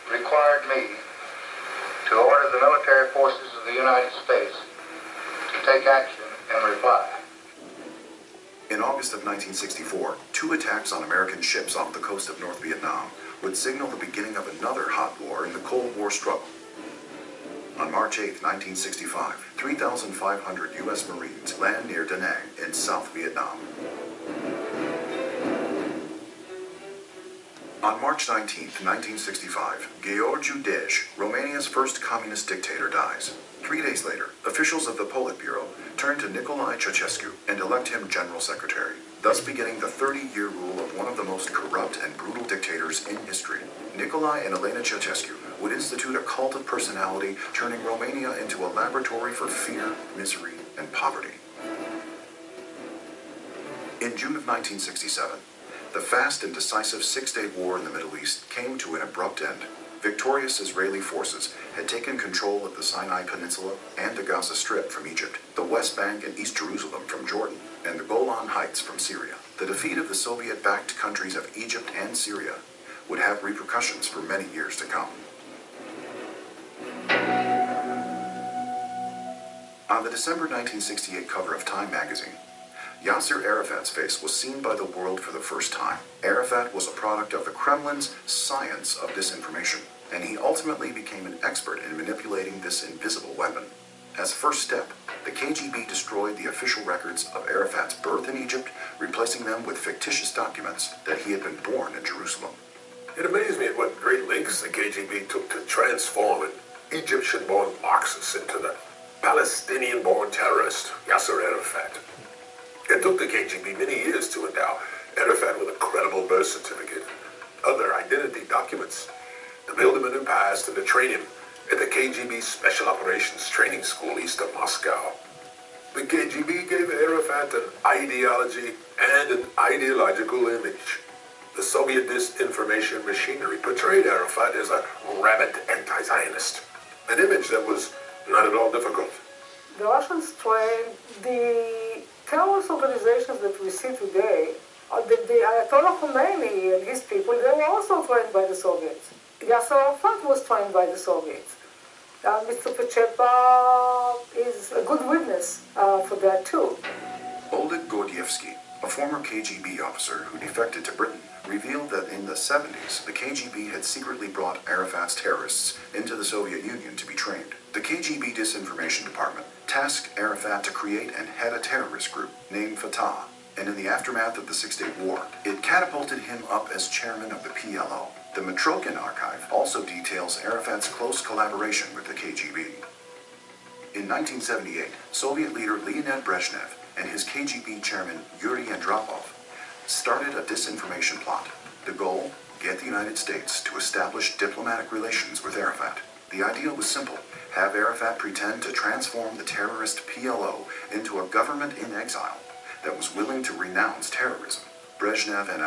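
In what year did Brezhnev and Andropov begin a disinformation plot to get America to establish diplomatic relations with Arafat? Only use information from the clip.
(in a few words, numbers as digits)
1978.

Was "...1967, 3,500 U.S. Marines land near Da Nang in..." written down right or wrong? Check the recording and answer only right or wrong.
wrong.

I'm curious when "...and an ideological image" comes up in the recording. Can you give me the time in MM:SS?
02:09.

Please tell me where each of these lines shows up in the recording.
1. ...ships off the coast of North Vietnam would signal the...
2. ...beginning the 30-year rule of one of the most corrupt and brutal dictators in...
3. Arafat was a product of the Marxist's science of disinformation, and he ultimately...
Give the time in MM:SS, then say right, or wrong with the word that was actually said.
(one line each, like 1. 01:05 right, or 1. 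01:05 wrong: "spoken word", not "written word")
1. 00:11 right
2. 00:39 right
3. 01:26 wrong: "Kremlin", not "Marxist".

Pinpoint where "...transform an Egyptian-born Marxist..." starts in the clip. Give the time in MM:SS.
01:45.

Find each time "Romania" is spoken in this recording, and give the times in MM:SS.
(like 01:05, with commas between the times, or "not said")
00:31, 00:47.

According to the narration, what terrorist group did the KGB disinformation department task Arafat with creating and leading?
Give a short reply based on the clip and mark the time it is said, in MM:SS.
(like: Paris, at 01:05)
Fatah, at 02:52.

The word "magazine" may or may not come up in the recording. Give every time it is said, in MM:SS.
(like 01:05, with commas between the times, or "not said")
01:21.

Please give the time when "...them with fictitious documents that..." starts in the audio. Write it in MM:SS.
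01:39.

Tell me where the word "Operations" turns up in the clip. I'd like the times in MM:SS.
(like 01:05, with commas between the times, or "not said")
02:02.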